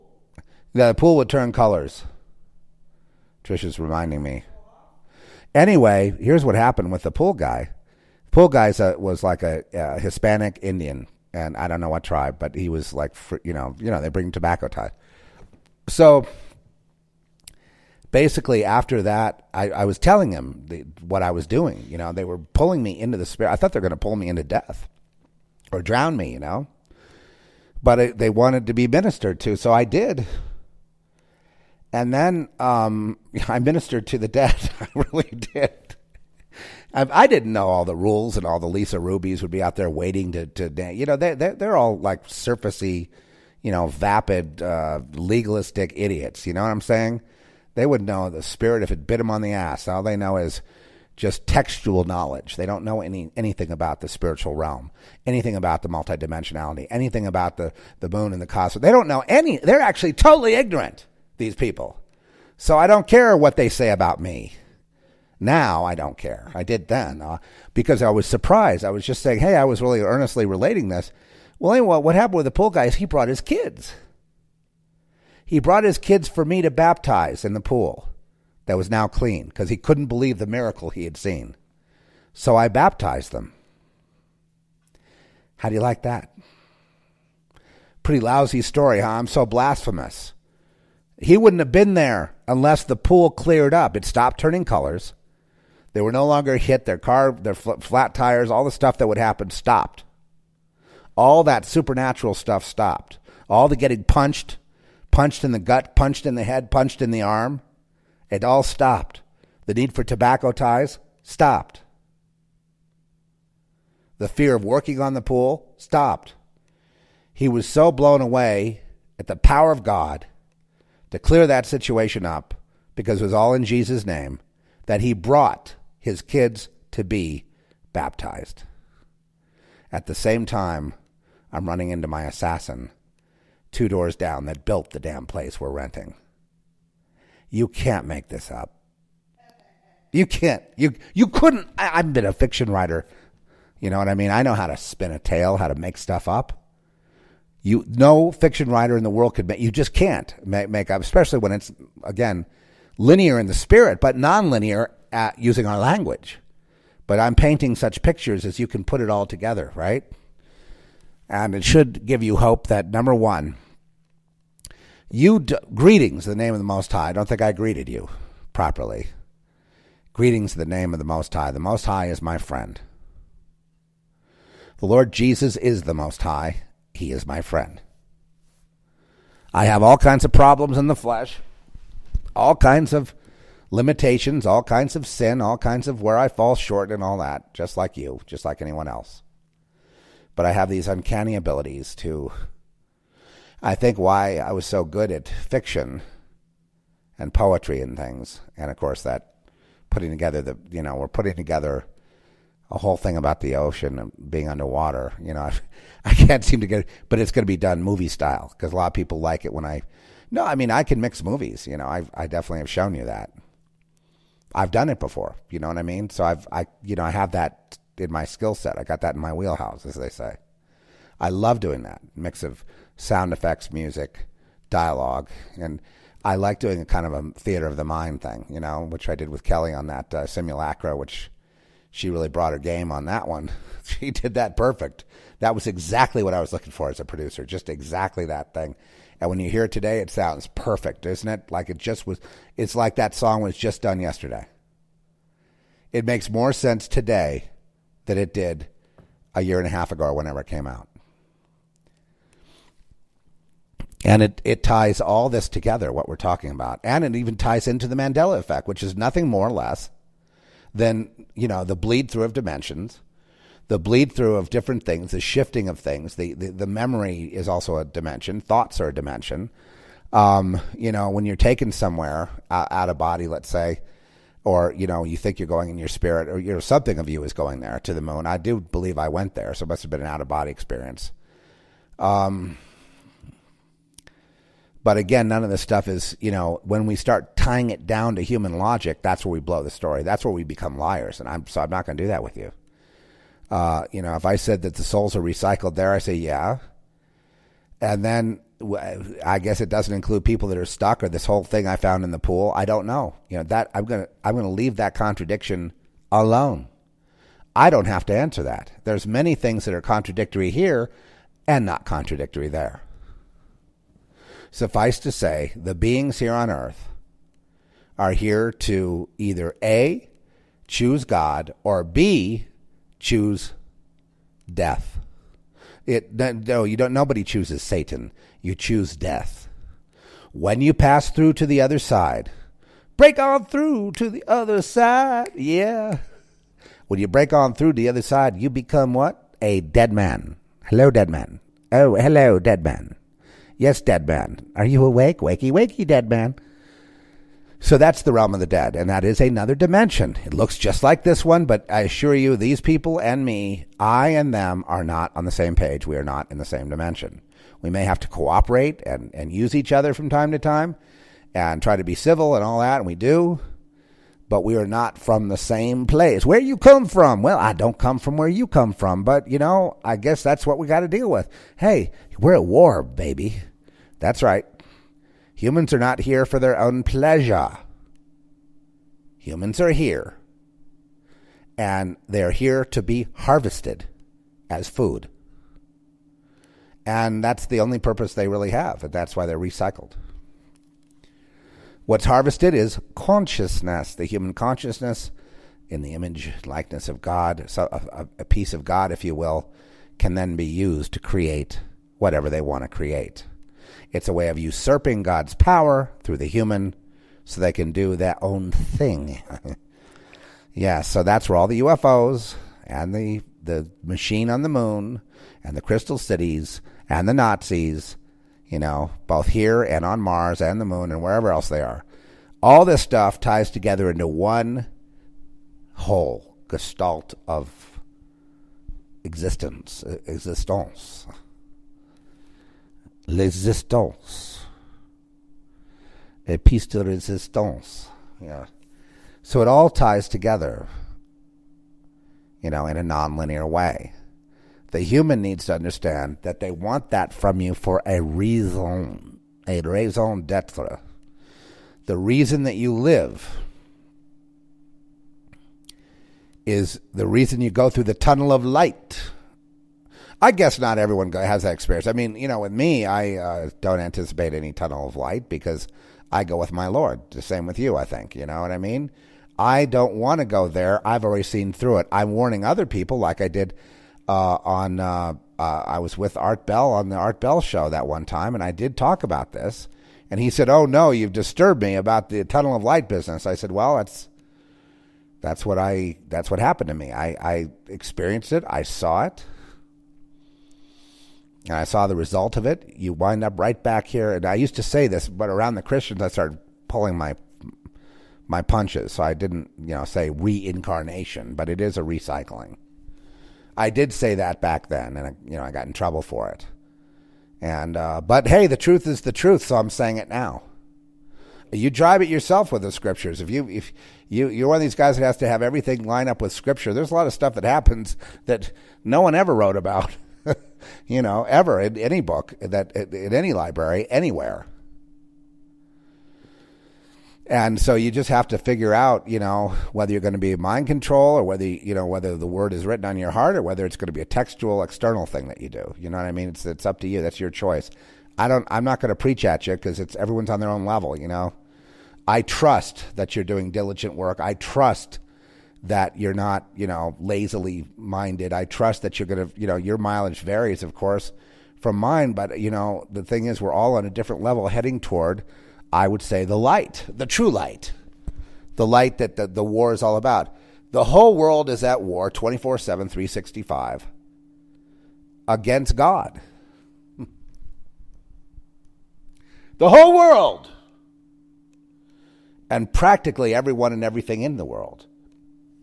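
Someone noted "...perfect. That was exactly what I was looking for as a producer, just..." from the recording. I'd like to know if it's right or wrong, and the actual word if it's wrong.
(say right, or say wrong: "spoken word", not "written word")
right.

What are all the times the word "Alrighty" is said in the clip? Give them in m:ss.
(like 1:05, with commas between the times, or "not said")
not said.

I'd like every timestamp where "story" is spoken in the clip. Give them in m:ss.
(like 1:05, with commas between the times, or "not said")
1:28, 4:49.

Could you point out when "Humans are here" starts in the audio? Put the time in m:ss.
6:19.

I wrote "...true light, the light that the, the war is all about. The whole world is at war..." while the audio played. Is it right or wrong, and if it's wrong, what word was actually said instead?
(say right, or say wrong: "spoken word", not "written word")
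right.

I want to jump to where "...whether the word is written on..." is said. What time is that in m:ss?
8:51.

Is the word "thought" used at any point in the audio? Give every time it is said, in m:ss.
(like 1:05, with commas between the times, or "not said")
0:23, 4:28.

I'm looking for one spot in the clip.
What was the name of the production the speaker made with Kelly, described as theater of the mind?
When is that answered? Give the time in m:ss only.
3:50.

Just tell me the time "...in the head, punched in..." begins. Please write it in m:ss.
1:46.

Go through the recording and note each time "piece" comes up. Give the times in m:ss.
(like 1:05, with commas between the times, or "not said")
6:38, 7:16.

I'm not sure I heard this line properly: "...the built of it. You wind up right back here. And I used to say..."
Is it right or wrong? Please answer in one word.
wrong.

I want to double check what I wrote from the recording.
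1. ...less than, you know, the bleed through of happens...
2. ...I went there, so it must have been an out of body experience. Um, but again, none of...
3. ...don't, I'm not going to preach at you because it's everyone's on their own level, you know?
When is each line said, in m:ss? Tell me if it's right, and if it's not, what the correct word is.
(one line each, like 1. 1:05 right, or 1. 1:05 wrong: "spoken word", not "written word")
1. 4:19 wrong: "dimensions", not "happens"
2. 4:38 right
3. 8:58 right.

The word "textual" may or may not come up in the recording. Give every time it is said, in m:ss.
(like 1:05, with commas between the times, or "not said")
0:51, 8:54.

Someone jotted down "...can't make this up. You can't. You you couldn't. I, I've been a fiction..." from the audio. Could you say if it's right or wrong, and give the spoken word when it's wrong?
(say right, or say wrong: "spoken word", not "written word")
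right.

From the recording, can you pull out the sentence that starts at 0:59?
They're actually totally ignorant, these people.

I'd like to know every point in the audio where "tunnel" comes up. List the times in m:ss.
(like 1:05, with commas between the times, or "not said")
7:37, 7:44, 8:02.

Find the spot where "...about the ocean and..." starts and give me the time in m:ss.
3:23.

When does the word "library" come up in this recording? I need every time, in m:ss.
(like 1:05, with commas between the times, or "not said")
8:43.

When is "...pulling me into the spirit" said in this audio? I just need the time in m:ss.
0:22.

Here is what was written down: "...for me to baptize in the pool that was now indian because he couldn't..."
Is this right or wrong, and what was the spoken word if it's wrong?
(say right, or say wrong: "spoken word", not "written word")
wrong: "clean", not "indian".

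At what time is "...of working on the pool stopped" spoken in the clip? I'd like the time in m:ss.
1:54.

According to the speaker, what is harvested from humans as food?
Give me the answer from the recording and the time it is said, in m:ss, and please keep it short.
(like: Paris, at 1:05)
human consciousness, at 6:33.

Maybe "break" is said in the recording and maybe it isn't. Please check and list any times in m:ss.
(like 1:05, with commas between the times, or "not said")
5:32, 5:37.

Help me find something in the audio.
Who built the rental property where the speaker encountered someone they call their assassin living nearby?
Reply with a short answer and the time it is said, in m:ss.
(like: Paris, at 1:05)
assassin two doors down, at 2:12.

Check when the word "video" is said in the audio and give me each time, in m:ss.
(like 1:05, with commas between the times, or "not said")
not said.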